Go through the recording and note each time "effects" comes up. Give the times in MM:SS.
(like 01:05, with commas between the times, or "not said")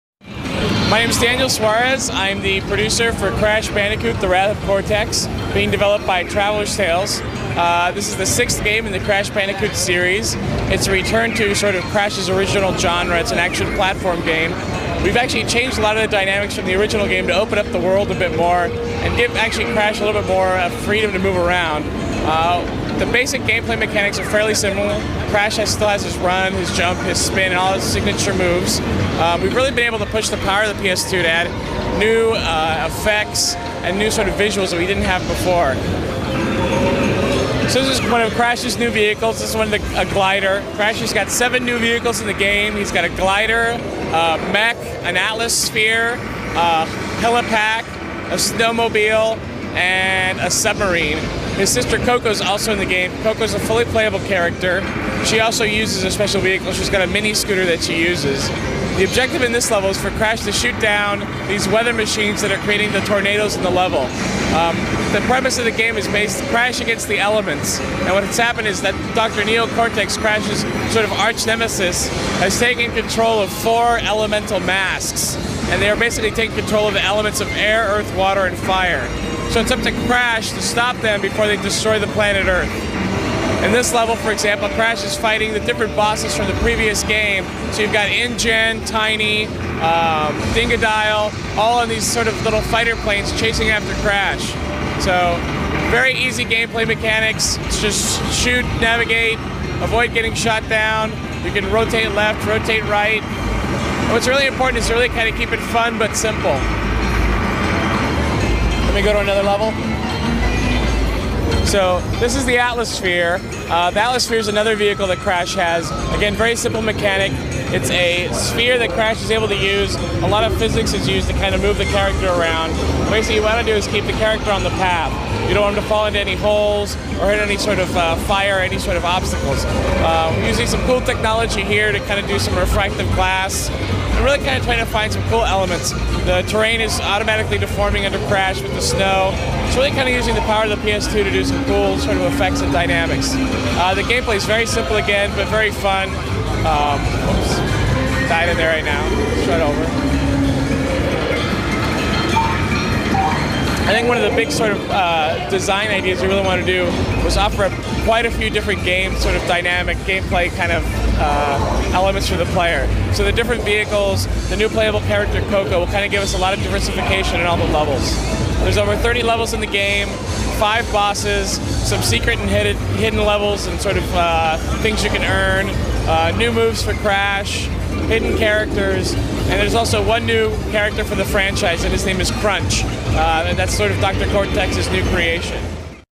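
00:32, 02:22.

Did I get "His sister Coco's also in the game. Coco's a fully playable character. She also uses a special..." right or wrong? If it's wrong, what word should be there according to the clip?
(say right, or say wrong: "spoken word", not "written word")
right.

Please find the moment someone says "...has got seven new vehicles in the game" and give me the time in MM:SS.
00:40.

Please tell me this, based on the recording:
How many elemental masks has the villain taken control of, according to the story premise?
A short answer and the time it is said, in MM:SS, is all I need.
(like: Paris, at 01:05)
4, at 01:13.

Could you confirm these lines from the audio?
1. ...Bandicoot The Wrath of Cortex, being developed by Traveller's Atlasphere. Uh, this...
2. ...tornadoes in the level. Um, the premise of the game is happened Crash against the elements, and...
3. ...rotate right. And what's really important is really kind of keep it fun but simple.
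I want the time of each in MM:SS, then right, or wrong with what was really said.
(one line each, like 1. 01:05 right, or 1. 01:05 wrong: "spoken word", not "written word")
1. 00:03 wrong: "Tales", not "Atlasphere"
2. 01:03 wrong: "based", not "happened"
3. 01:42 right.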